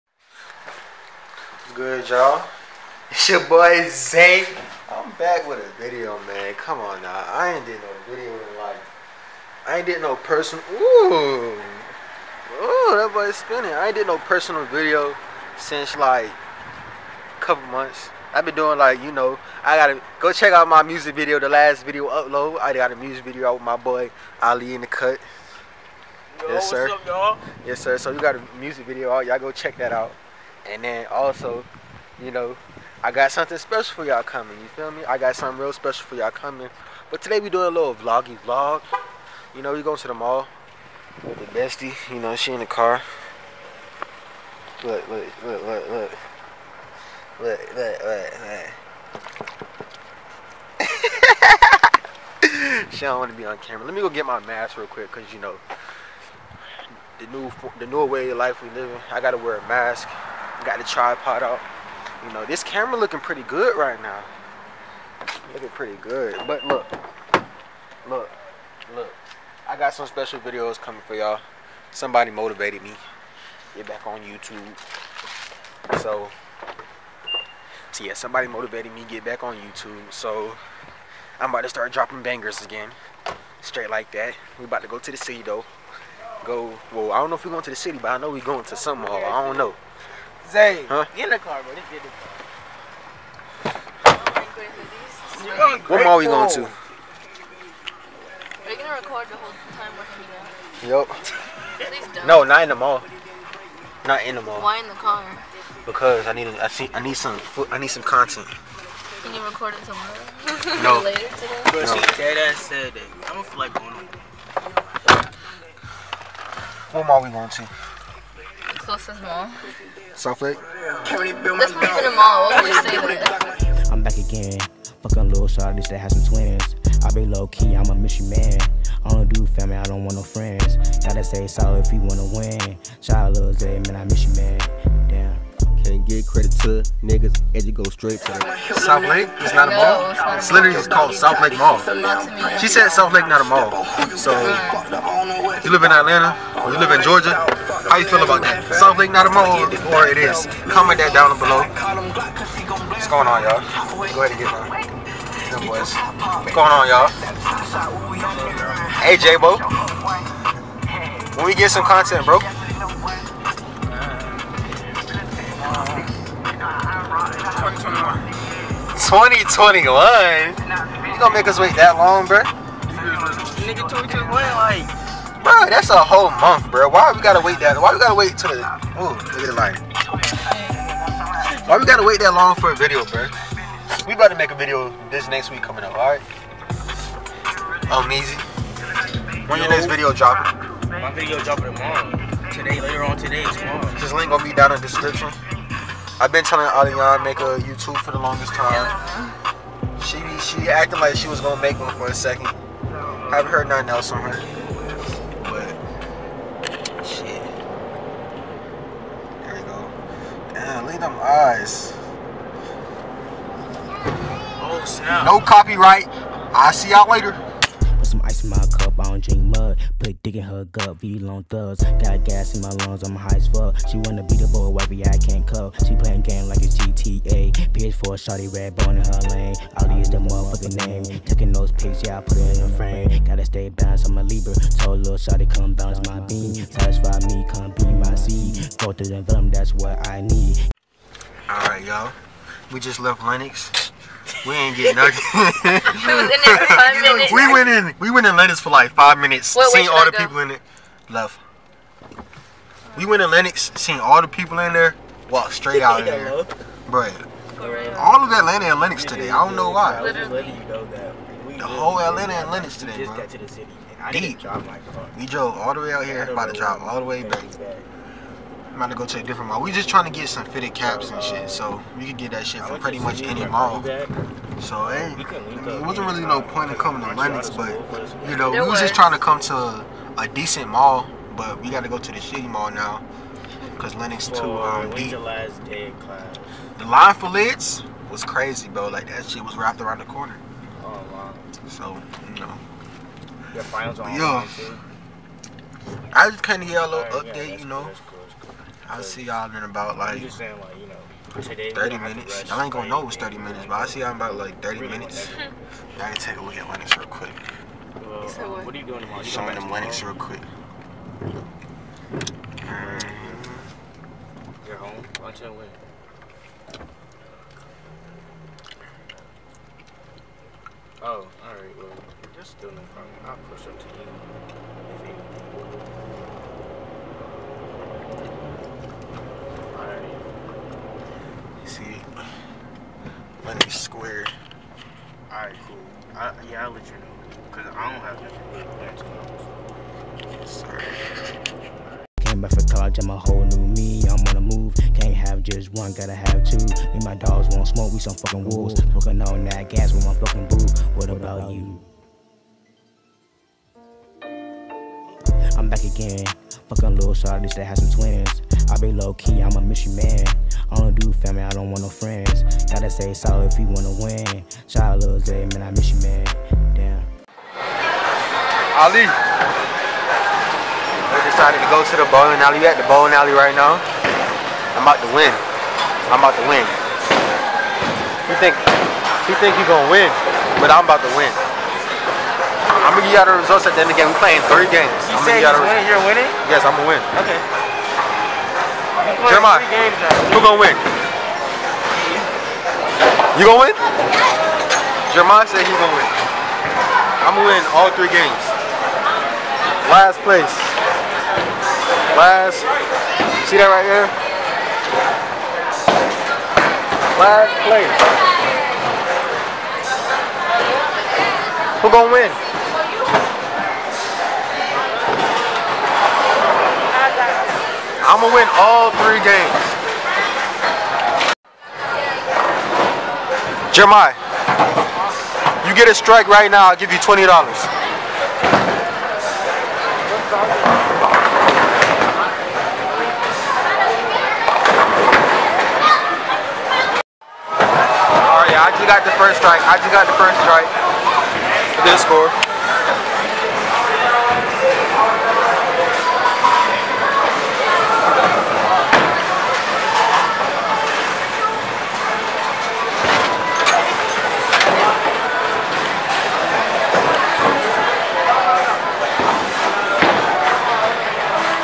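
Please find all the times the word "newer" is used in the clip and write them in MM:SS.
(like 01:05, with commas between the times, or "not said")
00:57.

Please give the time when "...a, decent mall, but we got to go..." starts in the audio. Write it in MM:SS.
04:40.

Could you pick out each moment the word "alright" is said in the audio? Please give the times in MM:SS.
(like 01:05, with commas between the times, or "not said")
04:01, 05:21, 07:07.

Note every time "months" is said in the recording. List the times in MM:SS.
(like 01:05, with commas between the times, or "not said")
00:17, 02:56.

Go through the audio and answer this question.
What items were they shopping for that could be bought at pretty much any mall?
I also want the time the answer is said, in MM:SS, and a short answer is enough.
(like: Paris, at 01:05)
fitted caps, at 04:30.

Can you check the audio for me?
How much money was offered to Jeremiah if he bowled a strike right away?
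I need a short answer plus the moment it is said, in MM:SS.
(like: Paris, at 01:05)
$20, at 07:06.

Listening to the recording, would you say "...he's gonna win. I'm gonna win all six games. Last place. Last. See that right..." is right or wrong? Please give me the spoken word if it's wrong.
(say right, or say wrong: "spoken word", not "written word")
wrong: "three", not "six".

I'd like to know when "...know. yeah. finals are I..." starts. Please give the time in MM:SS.
04:52.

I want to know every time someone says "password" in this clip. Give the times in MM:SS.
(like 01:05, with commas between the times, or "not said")
not said.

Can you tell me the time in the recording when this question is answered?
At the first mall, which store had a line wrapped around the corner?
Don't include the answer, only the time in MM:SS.
04:47.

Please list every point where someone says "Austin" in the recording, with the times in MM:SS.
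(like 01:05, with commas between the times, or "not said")
not said.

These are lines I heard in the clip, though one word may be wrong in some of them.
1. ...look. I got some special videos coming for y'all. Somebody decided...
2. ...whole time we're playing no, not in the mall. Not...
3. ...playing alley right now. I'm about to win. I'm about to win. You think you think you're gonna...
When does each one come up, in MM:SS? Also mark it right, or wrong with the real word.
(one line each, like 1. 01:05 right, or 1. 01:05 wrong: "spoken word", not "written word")
1. 01:08 wrong: "motivated", not "decided"
2. 01:39 wrong: "hanging", not "playing"
3. 06:12 wrong: "bowling", not "playing".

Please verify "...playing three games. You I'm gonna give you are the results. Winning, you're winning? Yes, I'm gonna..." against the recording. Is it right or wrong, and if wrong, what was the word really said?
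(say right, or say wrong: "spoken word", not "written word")
right.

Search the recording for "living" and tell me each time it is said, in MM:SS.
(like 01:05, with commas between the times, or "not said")
00:58.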